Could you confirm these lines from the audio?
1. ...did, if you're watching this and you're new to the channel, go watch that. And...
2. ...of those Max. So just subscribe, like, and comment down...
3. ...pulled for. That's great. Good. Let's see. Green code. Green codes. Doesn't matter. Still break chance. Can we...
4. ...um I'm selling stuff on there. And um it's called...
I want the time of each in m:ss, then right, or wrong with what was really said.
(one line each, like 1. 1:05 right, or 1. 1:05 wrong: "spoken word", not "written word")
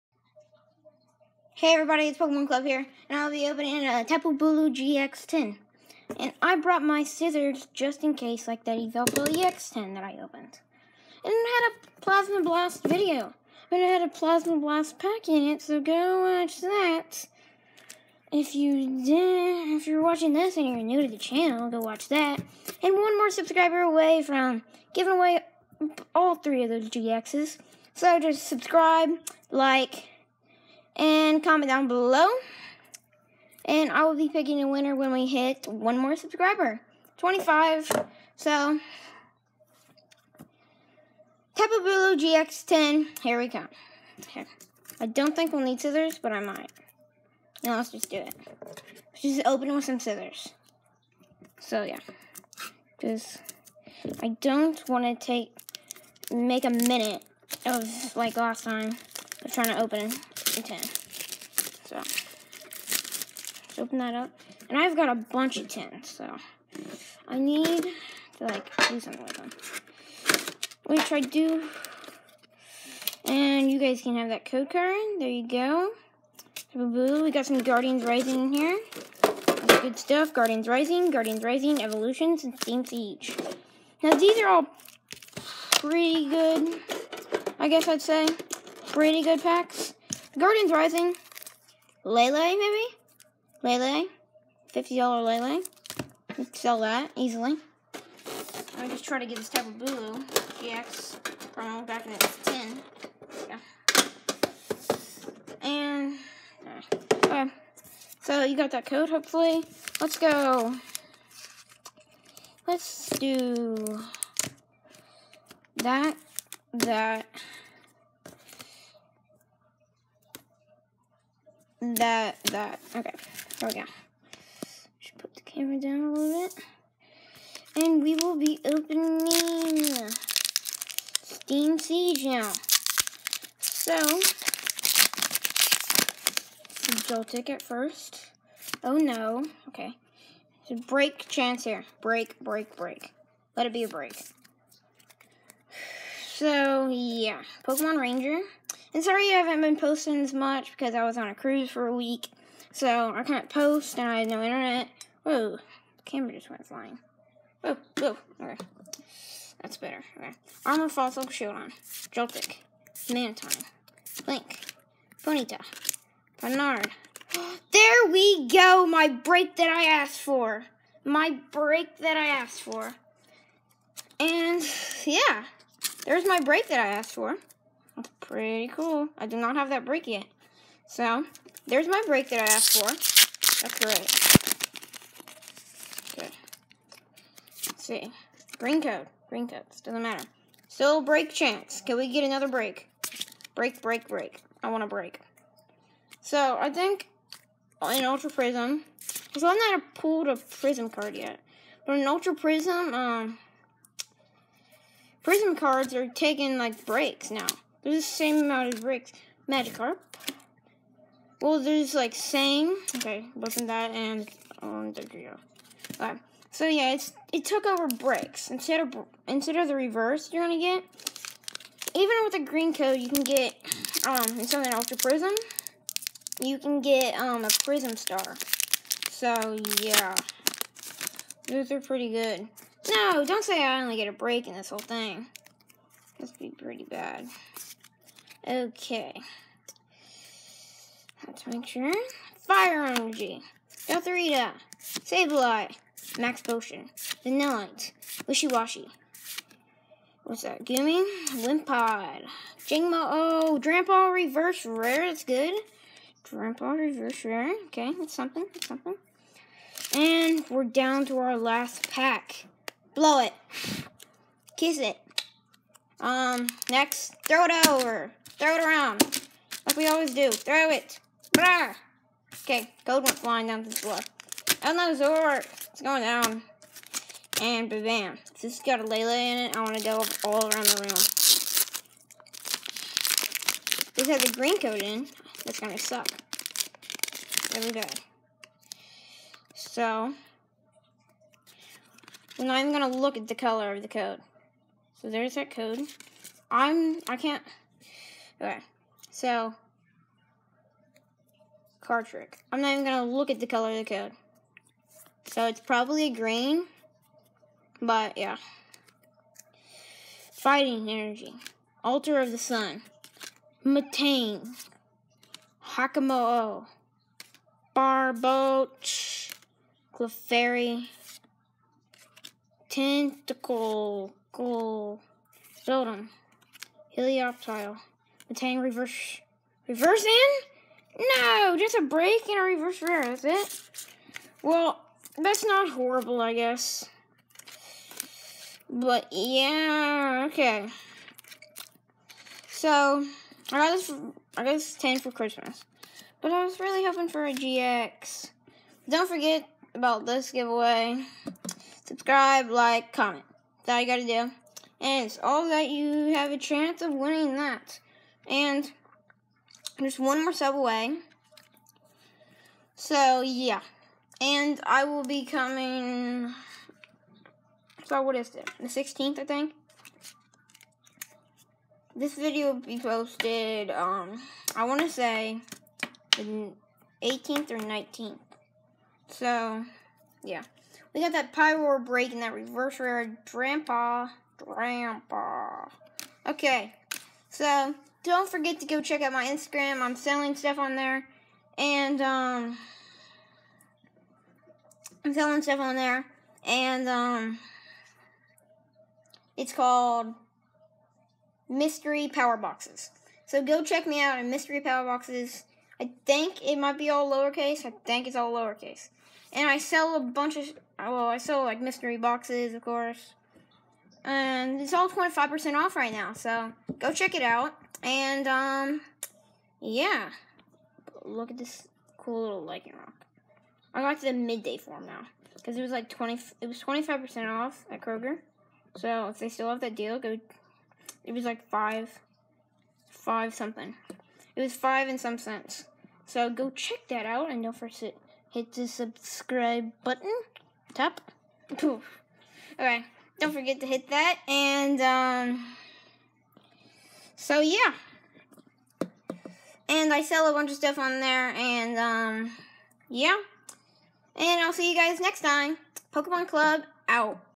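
1. 0:19 right
2. 0:26 wrong: "GXs", not "Max"
3. 3:02 wrong: "asked", not "pulled"
4. 6:32 right.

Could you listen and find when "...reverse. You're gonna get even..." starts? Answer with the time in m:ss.
3:39.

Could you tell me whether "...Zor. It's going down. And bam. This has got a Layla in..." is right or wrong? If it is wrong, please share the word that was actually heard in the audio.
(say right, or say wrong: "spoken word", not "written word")
right.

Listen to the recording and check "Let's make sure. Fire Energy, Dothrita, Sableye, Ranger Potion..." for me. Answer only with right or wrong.
wrong.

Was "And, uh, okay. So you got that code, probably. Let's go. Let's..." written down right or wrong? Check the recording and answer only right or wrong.
wrong.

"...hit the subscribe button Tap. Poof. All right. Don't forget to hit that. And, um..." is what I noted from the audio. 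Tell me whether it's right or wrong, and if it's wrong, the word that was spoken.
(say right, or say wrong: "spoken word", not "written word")
right.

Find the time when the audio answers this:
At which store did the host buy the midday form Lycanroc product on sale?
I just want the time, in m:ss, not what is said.
7:07.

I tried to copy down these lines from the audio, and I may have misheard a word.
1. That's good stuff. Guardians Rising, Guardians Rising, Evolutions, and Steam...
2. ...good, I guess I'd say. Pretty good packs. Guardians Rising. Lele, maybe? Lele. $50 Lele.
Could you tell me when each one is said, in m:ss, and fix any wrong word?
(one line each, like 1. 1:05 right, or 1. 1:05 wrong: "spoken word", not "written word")
1. 1:19 right
2. 1:26 right.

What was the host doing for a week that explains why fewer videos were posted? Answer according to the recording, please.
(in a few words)
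On a cruise.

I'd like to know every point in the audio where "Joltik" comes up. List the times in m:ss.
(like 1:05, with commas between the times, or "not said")
2:17, 2:42.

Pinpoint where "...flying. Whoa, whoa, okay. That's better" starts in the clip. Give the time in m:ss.
2:36.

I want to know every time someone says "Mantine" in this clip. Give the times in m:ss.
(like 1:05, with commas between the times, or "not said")
2:43, 5:13.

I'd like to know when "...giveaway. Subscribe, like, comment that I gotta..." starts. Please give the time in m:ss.
5:50.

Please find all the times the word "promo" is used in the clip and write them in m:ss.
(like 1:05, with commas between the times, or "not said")
1:41.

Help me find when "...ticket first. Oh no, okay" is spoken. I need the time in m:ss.
2:17.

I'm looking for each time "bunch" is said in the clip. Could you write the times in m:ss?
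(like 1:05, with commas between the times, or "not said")
1:05, 6:49, 7:30.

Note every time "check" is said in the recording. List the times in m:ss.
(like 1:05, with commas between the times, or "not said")
6:28, 6:43, 6:56, 7:16.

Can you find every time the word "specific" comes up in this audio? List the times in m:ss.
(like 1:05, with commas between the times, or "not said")
not said.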